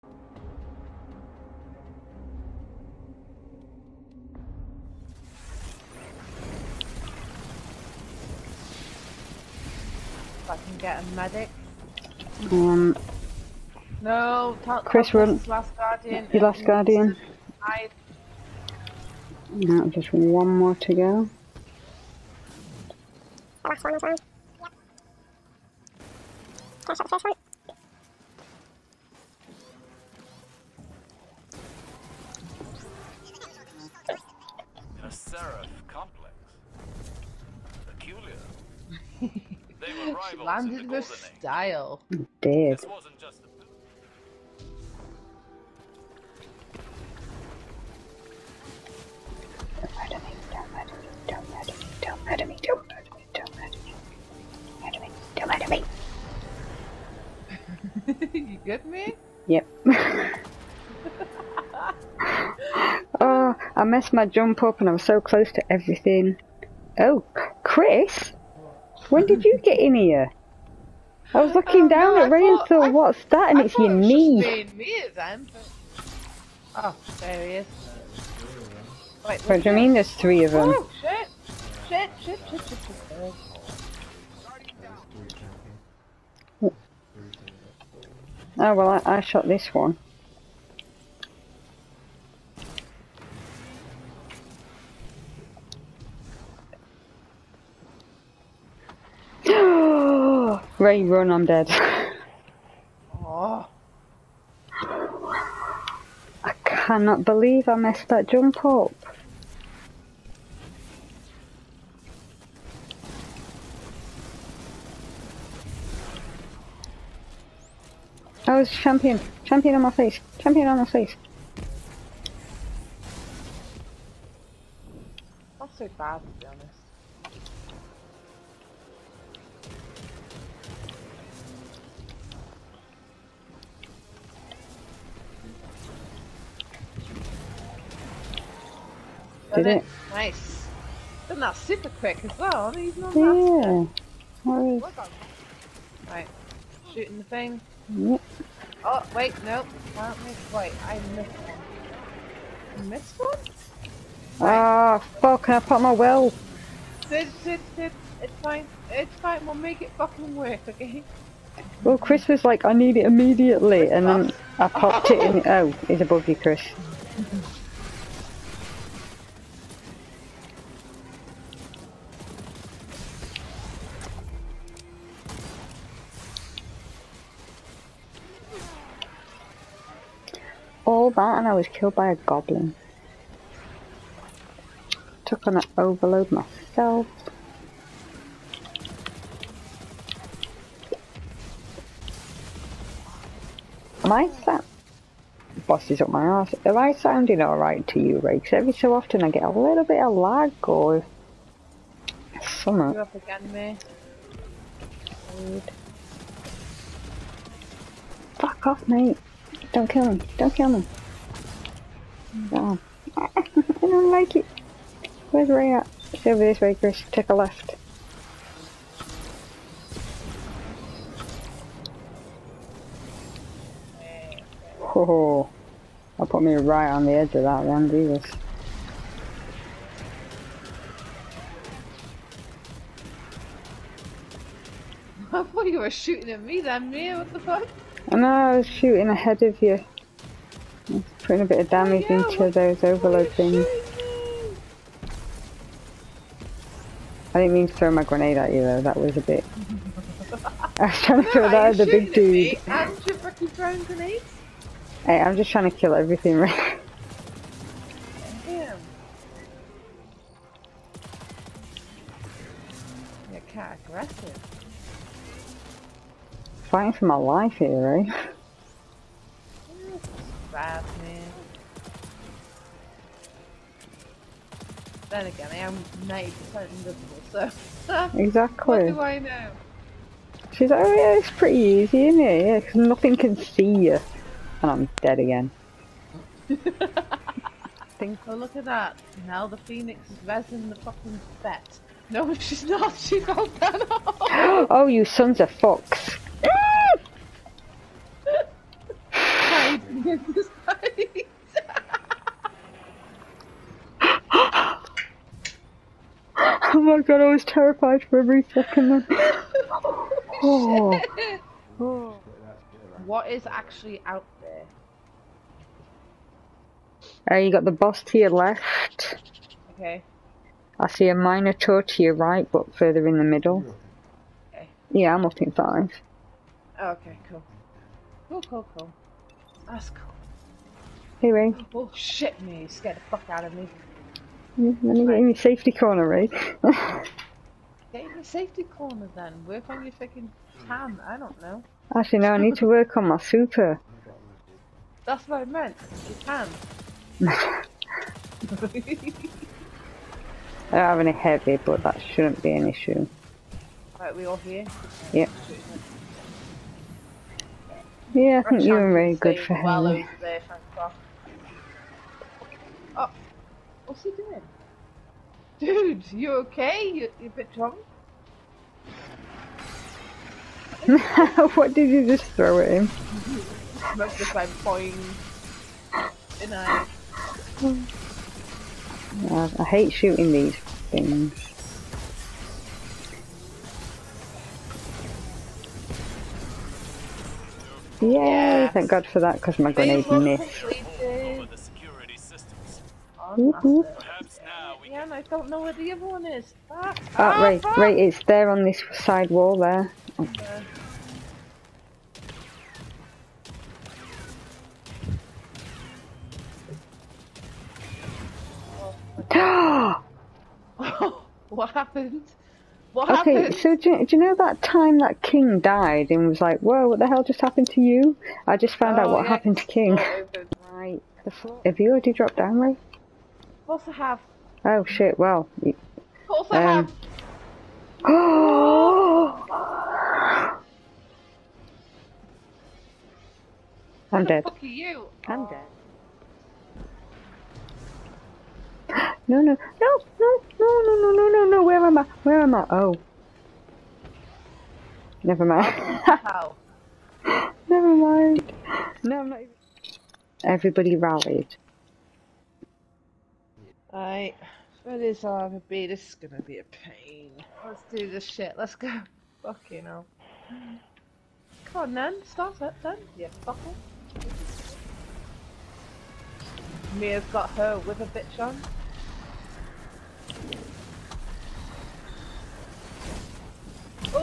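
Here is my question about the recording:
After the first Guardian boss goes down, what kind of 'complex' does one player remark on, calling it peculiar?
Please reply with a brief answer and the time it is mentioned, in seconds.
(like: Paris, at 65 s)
seraph complex, at 23 s.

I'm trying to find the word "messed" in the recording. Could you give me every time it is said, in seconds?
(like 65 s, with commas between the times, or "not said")
63 s, 107 s.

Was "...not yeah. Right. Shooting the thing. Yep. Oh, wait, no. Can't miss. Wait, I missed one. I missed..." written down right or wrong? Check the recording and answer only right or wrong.
right.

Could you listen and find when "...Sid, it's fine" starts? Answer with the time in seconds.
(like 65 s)
157 s.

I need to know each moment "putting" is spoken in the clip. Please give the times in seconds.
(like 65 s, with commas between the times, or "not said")
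241 s.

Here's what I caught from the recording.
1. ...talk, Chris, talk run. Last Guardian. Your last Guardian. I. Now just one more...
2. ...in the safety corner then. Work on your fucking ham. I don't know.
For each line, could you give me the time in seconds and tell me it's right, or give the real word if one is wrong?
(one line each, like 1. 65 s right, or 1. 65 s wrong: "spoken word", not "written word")
1. 14 s right
2. 337 s right.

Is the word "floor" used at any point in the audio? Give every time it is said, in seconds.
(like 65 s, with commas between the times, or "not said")
421 s.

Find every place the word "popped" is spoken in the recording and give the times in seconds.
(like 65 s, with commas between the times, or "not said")
164 s.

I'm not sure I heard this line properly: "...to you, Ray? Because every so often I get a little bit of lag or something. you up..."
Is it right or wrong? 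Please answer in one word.
right.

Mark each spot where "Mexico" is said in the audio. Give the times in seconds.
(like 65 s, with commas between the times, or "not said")
not said.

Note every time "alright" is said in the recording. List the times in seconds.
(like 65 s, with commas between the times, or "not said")
197 s, 453 s.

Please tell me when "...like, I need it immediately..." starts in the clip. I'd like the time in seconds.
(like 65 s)
162 s.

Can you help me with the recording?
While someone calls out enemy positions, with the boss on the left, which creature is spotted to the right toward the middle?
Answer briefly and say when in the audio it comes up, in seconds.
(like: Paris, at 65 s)
Minotaur, at 321 s.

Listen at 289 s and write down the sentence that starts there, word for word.
Now the phoenix is resin the fucking bet.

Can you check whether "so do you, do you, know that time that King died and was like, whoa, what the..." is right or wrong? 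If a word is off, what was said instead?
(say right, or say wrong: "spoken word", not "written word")
right.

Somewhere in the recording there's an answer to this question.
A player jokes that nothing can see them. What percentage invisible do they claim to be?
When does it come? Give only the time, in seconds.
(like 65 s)
276 s.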